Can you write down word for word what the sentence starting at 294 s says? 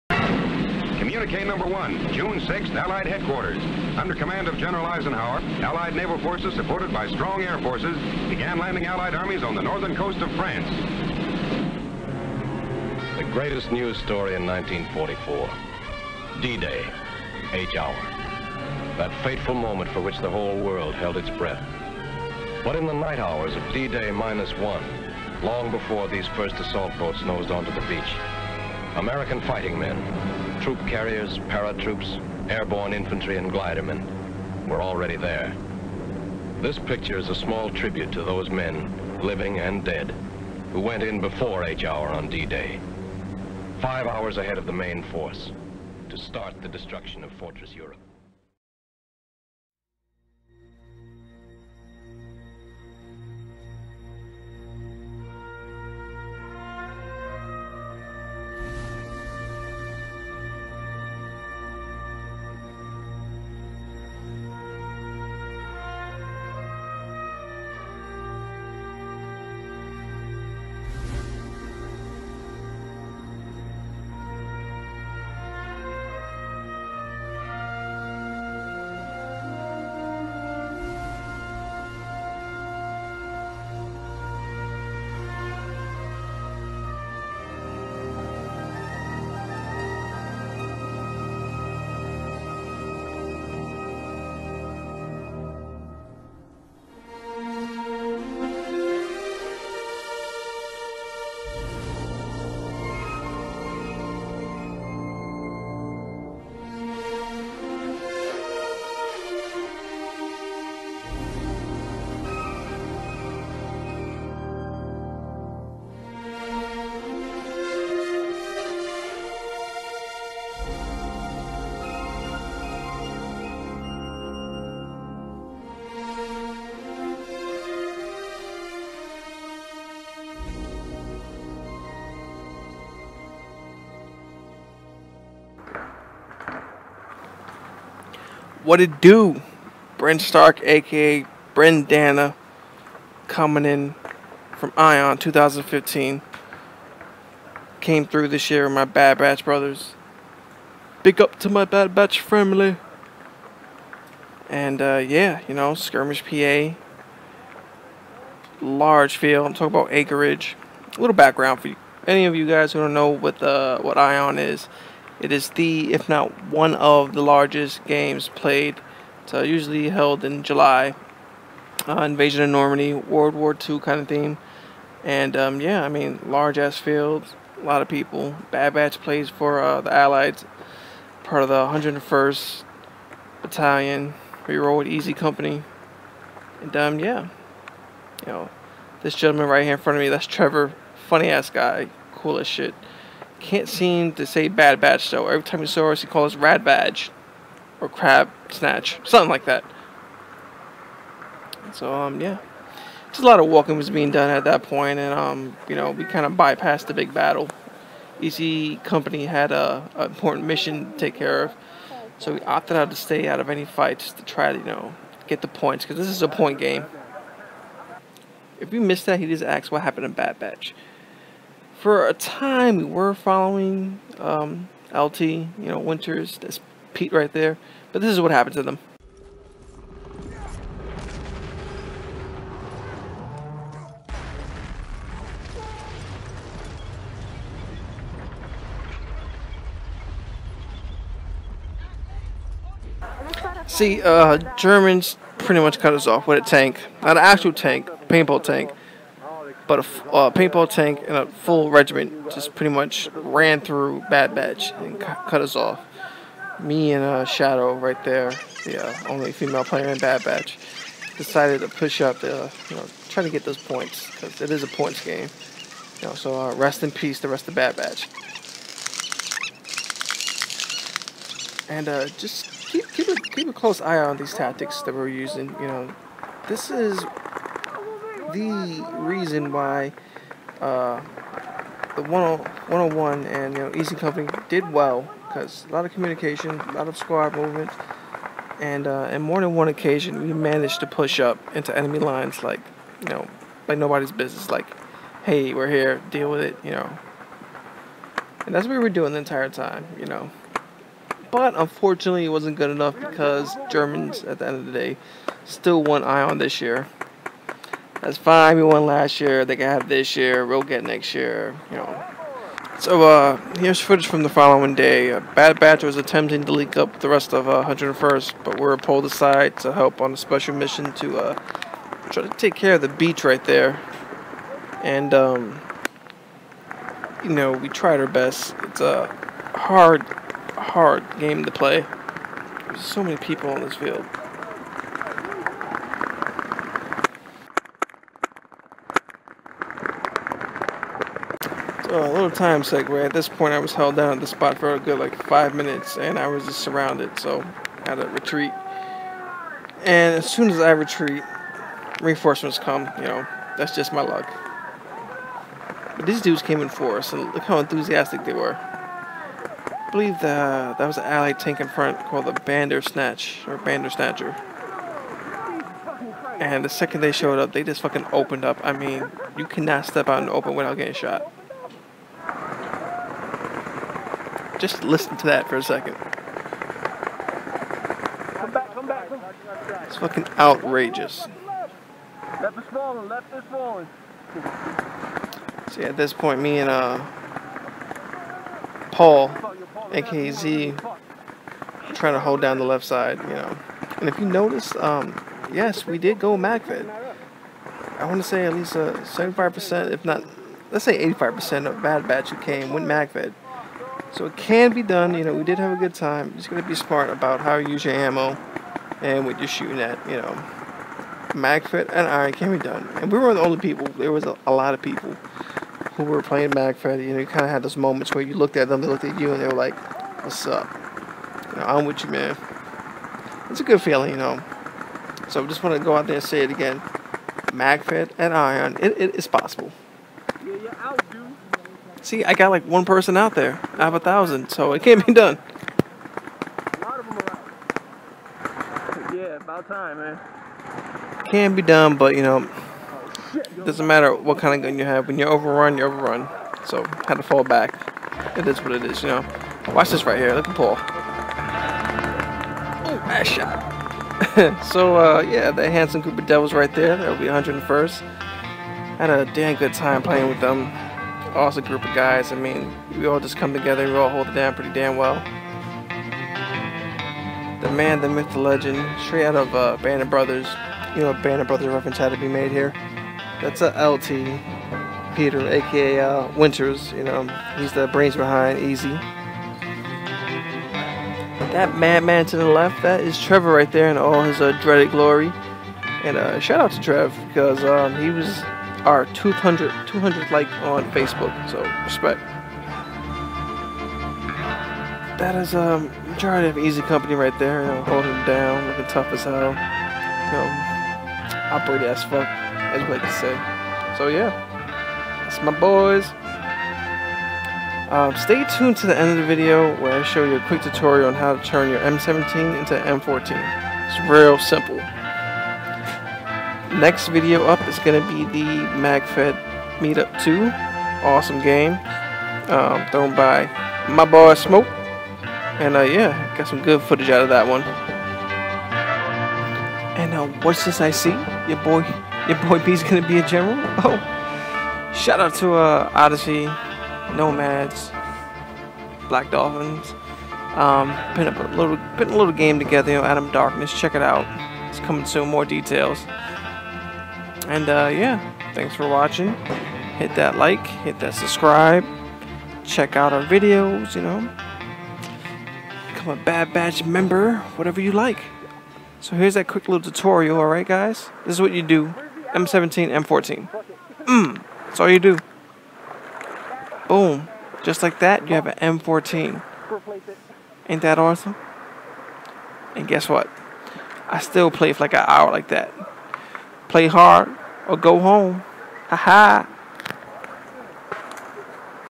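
Like, hey, we're here, deal with it, you know.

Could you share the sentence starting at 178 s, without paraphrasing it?
Bad Batch plays for uh, the Allies, part of the 101st Battalion, We roll with Easy Company.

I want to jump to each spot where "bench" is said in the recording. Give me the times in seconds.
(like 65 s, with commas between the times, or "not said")
not said.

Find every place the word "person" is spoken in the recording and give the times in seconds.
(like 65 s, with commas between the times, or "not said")
432 s.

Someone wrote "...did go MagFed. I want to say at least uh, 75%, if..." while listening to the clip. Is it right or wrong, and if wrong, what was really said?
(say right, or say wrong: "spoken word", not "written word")
right.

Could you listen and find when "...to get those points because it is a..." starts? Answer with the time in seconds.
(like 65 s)
263 s.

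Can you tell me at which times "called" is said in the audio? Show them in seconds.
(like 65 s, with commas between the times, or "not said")
196 s, 362 s.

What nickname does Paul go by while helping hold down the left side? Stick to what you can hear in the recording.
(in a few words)
Z.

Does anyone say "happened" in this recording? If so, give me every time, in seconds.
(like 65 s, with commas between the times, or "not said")
219 s, 228 s.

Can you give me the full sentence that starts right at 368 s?
I mean, you cannot step out in the open without getting shot.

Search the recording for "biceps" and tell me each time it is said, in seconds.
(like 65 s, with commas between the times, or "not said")
not said.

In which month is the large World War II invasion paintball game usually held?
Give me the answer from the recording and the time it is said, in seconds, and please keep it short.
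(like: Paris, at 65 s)
July, at 170 s.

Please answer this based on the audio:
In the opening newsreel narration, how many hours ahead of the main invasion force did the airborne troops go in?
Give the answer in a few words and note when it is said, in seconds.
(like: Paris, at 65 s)
5 hours, at 43 s.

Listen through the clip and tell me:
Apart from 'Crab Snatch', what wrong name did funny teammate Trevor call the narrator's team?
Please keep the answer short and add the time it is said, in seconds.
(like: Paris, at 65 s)
Rad Badge, at 196 s.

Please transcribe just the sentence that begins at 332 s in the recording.
There's so many people on this field.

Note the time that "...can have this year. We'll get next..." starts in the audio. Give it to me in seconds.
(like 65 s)
309 s.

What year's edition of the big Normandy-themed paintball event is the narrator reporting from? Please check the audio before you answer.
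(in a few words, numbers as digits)
2015.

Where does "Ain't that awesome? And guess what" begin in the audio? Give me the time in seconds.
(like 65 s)
570 s.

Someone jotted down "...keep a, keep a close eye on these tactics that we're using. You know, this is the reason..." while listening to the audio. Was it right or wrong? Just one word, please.
right.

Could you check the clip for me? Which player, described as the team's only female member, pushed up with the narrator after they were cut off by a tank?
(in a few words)
Shadow.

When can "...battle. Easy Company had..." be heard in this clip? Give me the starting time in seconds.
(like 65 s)
207 s.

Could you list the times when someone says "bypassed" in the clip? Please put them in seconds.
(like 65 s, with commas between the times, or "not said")
206 s.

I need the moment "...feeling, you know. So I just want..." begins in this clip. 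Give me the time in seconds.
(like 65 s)
423 s.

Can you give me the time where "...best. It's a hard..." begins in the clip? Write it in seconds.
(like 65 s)
328 s.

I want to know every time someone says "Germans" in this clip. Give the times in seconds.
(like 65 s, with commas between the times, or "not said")
244 s, 303 s.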